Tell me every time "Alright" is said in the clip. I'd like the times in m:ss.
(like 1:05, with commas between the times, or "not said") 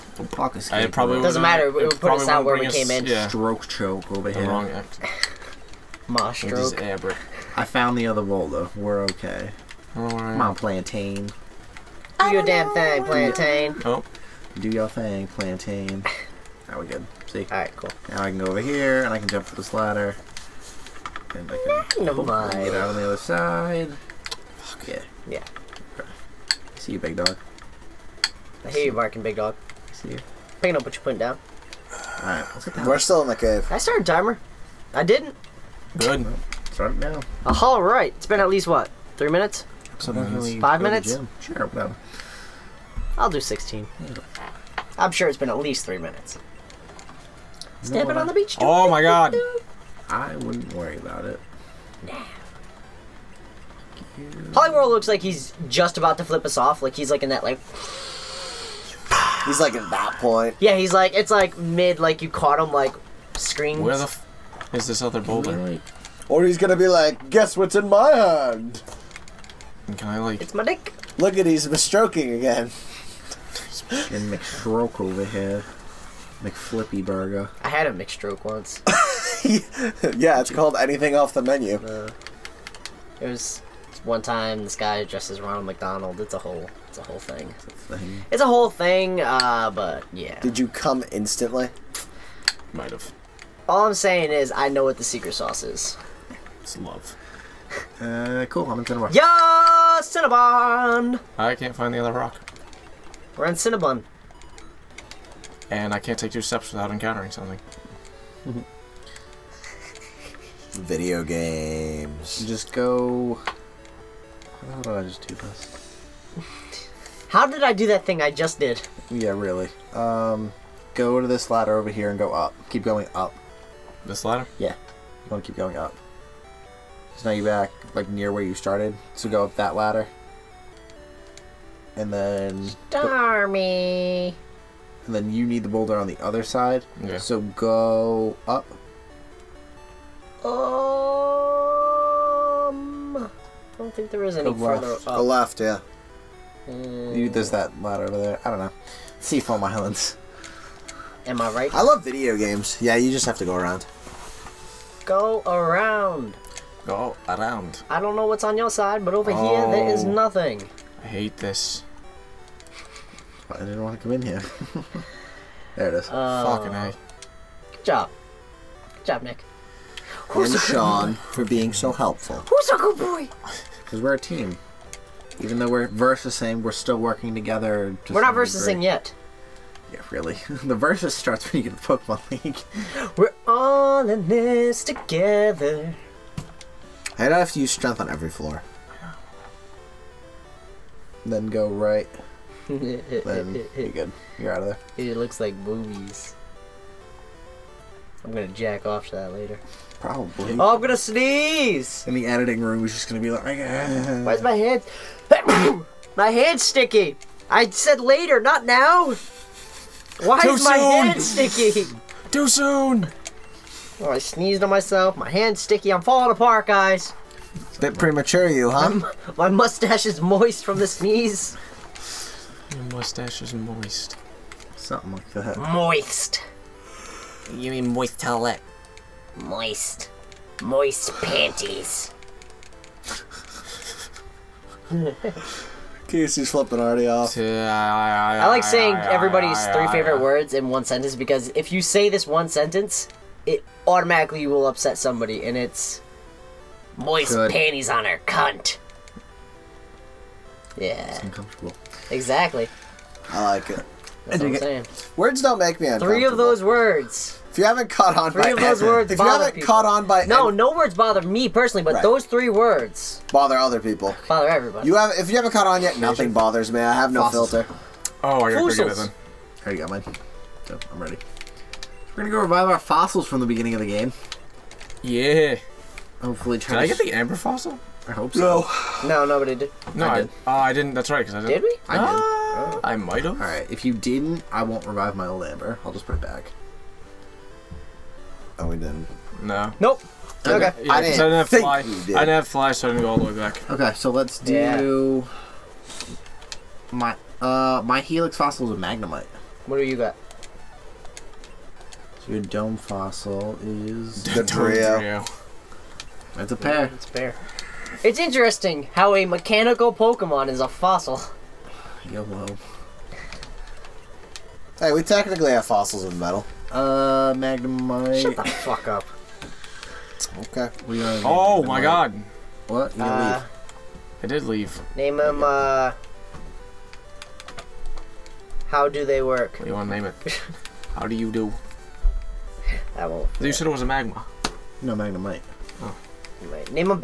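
0:17, 0:32.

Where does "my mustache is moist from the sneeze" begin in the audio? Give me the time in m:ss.
3:39.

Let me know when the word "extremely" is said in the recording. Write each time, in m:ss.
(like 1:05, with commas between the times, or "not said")
not said.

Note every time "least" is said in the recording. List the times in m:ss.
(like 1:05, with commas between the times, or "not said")
0:38, 0:45.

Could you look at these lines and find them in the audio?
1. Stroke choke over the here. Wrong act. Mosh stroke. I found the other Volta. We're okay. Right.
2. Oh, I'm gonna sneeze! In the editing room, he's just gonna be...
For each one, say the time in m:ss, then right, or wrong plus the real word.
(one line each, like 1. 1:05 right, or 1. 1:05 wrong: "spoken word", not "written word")
1. 0:03 right
2. 3:20 right.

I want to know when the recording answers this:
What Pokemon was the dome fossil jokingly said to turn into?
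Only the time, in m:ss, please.
5:04.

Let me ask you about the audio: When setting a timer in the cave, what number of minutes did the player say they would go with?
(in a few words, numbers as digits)
16.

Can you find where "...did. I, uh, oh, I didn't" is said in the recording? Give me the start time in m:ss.
4:40.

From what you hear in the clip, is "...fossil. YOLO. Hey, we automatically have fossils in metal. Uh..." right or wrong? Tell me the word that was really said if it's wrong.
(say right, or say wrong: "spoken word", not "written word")
wrong: "technically", not "automatically".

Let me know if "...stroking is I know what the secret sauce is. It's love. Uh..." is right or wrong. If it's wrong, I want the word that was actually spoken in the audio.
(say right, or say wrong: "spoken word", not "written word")
wrong: "saying", not "stroking".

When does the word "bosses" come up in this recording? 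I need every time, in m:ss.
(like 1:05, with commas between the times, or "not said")
not said.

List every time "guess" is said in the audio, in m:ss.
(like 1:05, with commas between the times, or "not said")
1:07.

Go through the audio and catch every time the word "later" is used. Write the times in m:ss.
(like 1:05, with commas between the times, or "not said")
3:19, 3:28.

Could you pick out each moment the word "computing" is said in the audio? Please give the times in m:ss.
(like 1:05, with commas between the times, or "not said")
not said.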